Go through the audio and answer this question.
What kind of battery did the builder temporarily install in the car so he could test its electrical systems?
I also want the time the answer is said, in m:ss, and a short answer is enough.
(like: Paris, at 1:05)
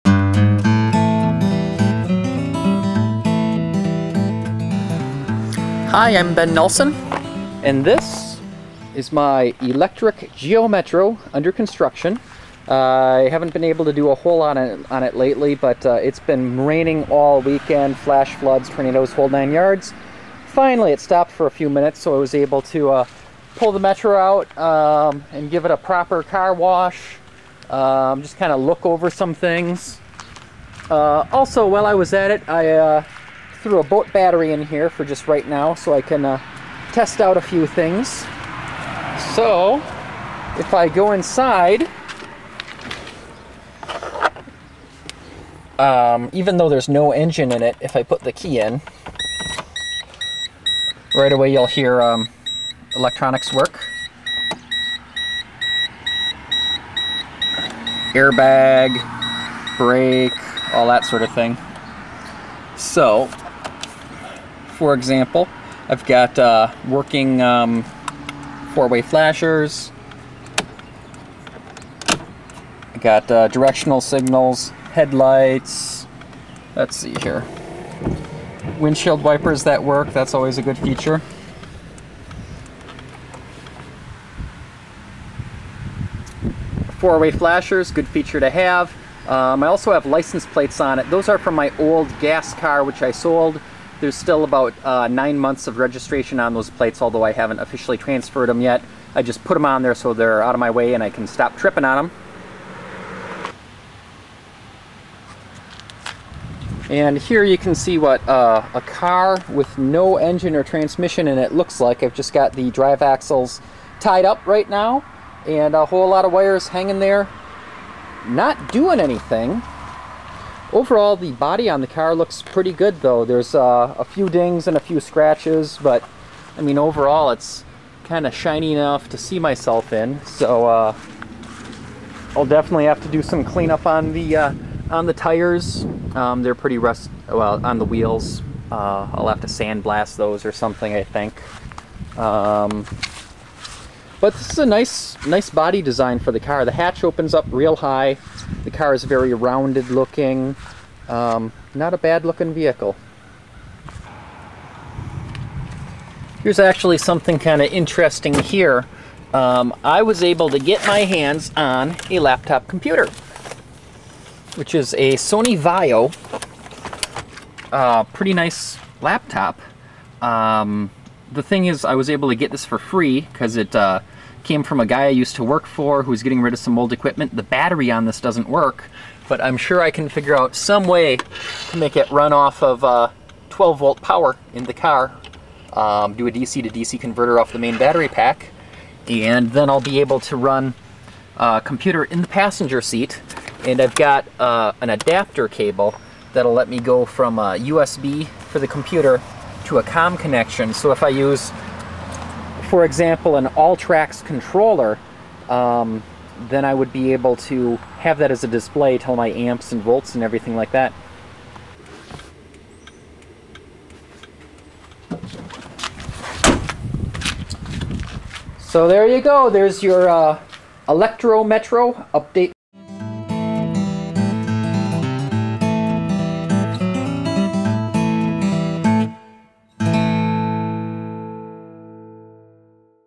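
boat battery, at 0:33.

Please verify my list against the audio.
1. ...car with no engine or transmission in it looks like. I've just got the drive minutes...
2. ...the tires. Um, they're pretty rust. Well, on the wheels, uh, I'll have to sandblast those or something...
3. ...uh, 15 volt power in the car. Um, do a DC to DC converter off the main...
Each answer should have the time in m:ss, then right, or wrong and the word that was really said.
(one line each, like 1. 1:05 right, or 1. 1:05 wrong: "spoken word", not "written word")
1. 1:48 wrong: "axles", not "minutes"
2. 2:15 right
3. 3:02 wrong: "12", not "15".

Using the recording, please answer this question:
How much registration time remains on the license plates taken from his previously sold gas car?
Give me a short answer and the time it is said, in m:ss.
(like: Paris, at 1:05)
9 months, at 1:35.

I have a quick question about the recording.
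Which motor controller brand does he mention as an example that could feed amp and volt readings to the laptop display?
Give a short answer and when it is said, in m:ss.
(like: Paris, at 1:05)
Alltrax, at 3:23.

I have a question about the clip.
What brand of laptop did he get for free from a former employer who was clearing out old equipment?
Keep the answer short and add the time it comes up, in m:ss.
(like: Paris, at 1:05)
Sony Vaio, at 2:45.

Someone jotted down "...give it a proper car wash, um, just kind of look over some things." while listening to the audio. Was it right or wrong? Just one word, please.
right.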